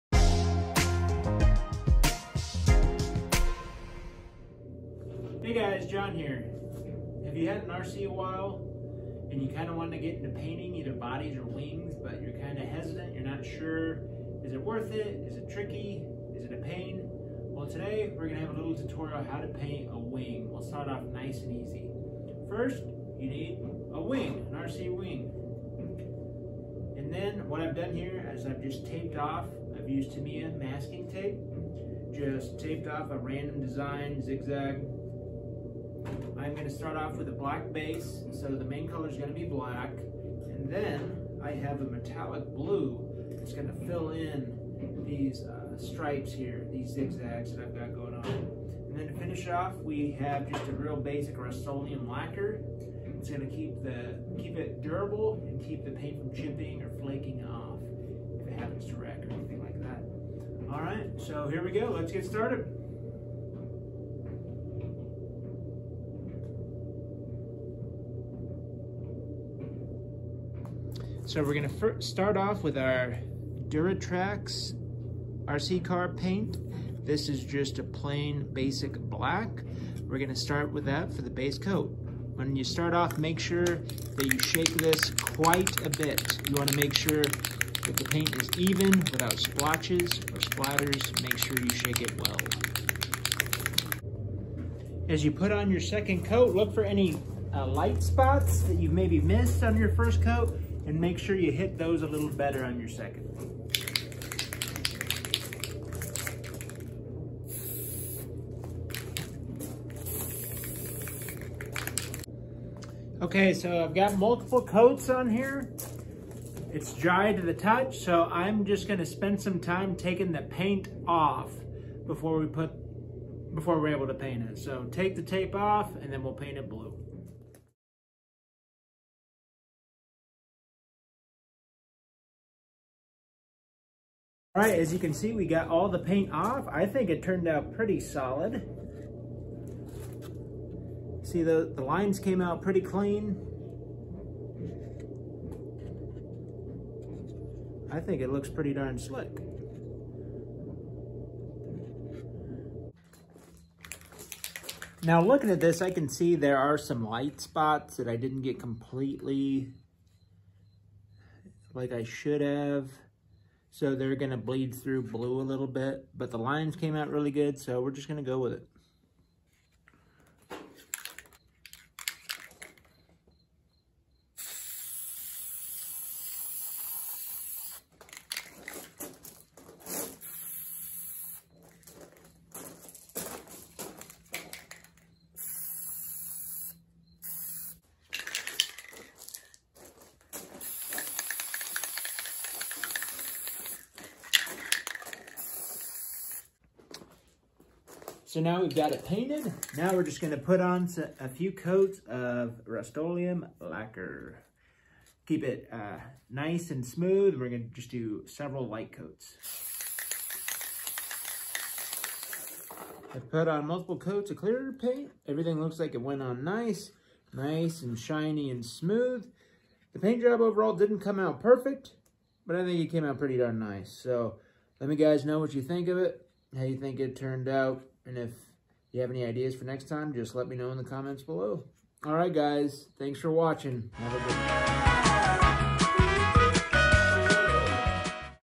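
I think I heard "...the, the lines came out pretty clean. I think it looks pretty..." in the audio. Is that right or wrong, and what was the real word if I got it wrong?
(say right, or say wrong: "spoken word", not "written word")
right.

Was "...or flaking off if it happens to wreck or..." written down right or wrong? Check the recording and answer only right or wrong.
right.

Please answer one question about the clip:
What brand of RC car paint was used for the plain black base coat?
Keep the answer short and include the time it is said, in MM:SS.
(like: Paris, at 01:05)
Duratrax, at 01:13.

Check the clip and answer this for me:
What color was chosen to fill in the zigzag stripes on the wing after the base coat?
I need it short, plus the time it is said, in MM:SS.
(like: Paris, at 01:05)
metallic blue, at 00:41.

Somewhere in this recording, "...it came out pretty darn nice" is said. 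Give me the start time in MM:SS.
03:42.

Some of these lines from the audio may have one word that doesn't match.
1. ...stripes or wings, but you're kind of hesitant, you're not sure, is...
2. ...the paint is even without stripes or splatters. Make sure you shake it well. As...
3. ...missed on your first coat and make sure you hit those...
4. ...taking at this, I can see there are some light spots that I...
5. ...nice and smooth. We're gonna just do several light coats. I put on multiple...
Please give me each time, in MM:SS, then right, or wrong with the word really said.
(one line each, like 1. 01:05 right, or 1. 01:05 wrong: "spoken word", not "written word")
1. 00:10 wrong: "bodies", not "stripes"
2. 01:27 wrong: "splotches", not "stripes"
3. 01:39 right
4. 02:35 wrong: "looking", not "taking"
5. 03:26 right.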